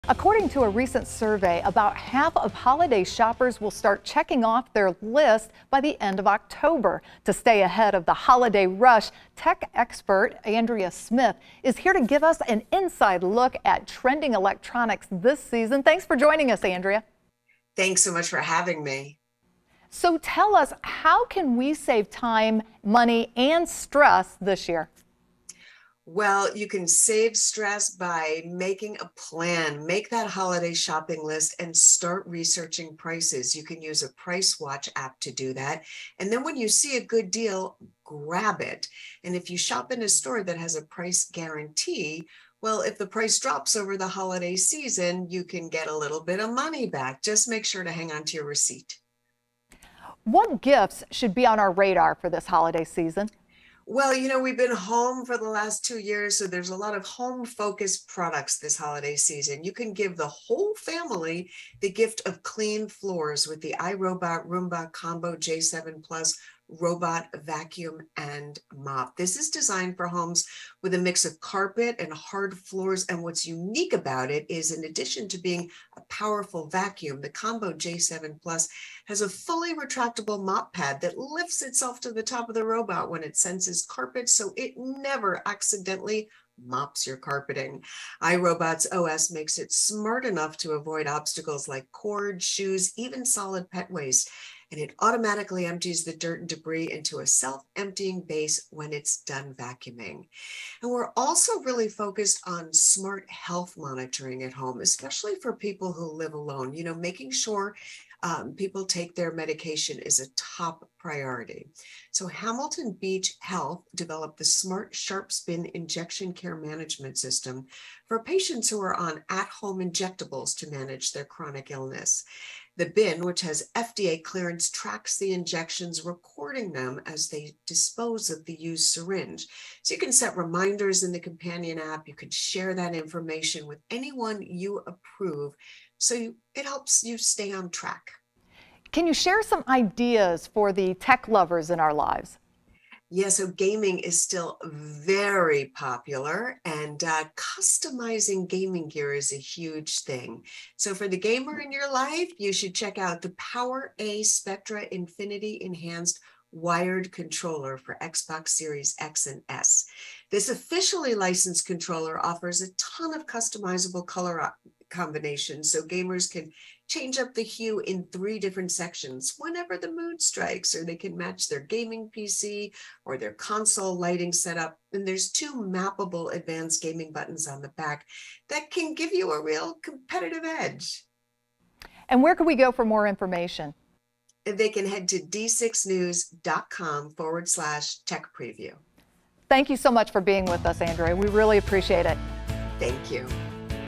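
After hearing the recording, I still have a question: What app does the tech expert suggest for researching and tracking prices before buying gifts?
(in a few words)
Price Watch app.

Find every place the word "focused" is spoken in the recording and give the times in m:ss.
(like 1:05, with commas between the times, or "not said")
0:57, 1:41.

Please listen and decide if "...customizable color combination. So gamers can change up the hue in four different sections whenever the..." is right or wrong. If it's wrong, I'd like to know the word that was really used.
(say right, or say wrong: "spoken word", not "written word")
wrong: "three", not "four".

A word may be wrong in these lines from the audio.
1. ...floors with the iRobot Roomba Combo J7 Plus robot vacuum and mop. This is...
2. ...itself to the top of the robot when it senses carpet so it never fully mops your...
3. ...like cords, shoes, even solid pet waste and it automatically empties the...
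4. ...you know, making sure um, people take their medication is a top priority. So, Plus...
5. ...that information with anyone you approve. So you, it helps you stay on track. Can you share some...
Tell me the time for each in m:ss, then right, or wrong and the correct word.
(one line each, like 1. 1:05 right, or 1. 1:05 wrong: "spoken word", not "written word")
1. 1:02 right
2. 1:21 wrong: "accidentally", not "fully"
3. 1:31 right
4. 1:46 wrong: "Hamilton", not "Plus"
5. 2:12 right.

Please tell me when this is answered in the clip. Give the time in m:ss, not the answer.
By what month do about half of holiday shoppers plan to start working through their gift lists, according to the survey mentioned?
0:06.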